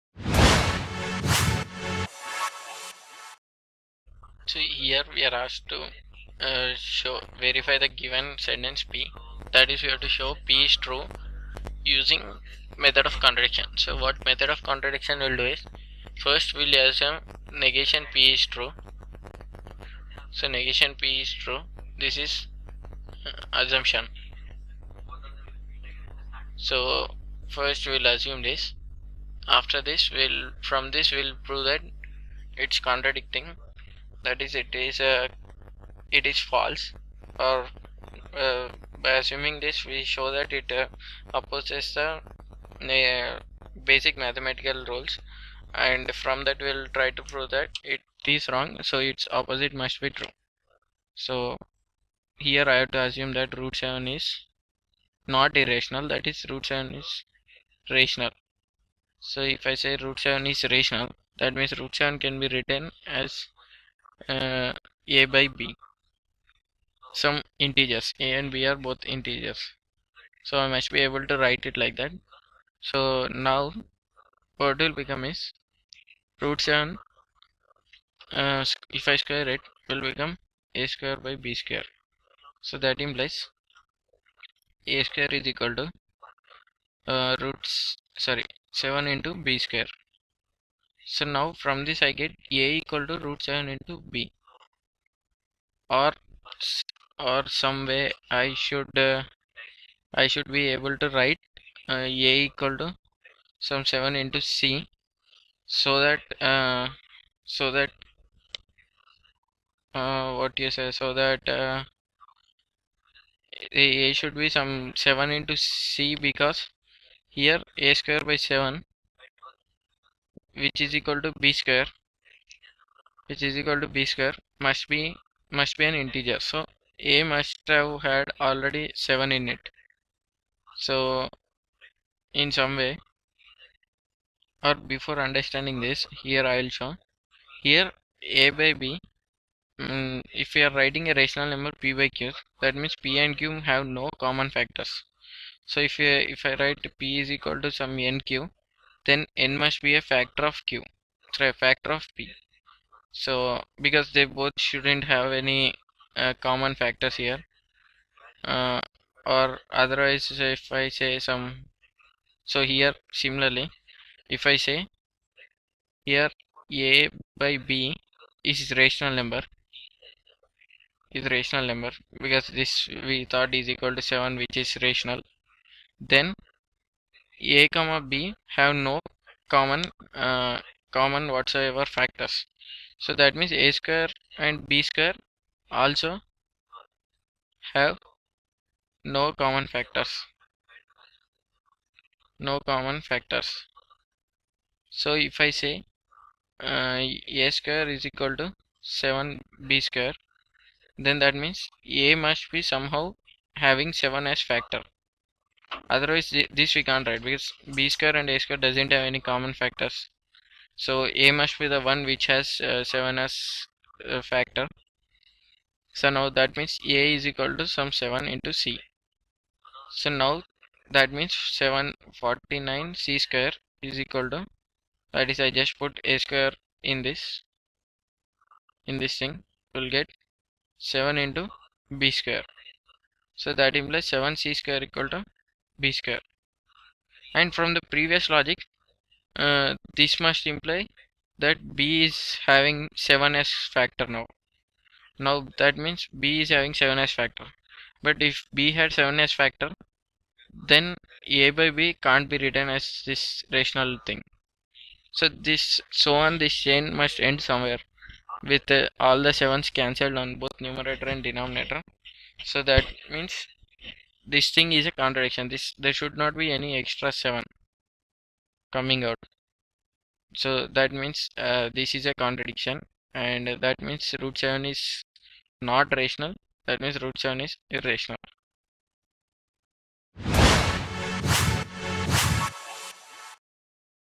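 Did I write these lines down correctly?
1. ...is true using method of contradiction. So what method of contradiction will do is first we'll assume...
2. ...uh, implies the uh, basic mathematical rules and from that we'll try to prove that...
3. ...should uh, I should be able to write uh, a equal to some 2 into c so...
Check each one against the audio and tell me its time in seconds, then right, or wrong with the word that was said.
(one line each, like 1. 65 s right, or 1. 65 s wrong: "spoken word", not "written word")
1. 10 s right
2. 40 s wrong: "opposes", not "implies"
3. 98 s wrong: "7", not "2".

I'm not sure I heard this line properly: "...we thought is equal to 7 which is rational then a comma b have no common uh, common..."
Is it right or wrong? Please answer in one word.
right.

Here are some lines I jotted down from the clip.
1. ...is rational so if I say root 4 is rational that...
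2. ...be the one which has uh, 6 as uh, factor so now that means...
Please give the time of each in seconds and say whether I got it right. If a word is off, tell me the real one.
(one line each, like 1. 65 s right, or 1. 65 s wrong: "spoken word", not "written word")
1. 56 s wrong: "7", not "4"
2. 211 s wrong: "7", not "6".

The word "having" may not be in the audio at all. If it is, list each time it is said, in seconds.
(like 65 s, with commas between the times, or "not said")
203 s, 242 s, 246 s.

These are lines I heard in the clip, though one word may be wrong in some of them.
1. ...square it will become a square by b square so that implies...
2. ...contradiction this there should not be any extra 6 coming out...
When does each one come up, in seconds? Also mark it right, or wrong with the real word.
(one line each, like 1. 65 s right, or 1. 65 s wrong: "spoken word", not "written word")
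1. 79 s right
2. 264 s wrong: "7", not "6".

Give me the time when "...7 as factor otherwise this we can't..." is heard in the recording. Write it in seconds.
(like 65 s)
203 s.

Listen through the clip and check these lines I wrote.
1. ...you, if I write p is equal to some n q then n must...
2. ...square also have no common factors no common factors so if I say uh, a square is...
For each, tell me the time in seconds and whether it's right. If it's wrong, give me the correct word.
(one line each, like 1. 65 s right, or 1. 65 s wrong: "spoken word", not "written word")
1. 145 s right
2. 184 s right.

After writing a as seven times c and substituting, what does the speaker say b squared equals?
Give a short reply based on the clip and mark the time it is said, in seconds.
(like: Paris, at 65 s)
7 c square, at 234 s.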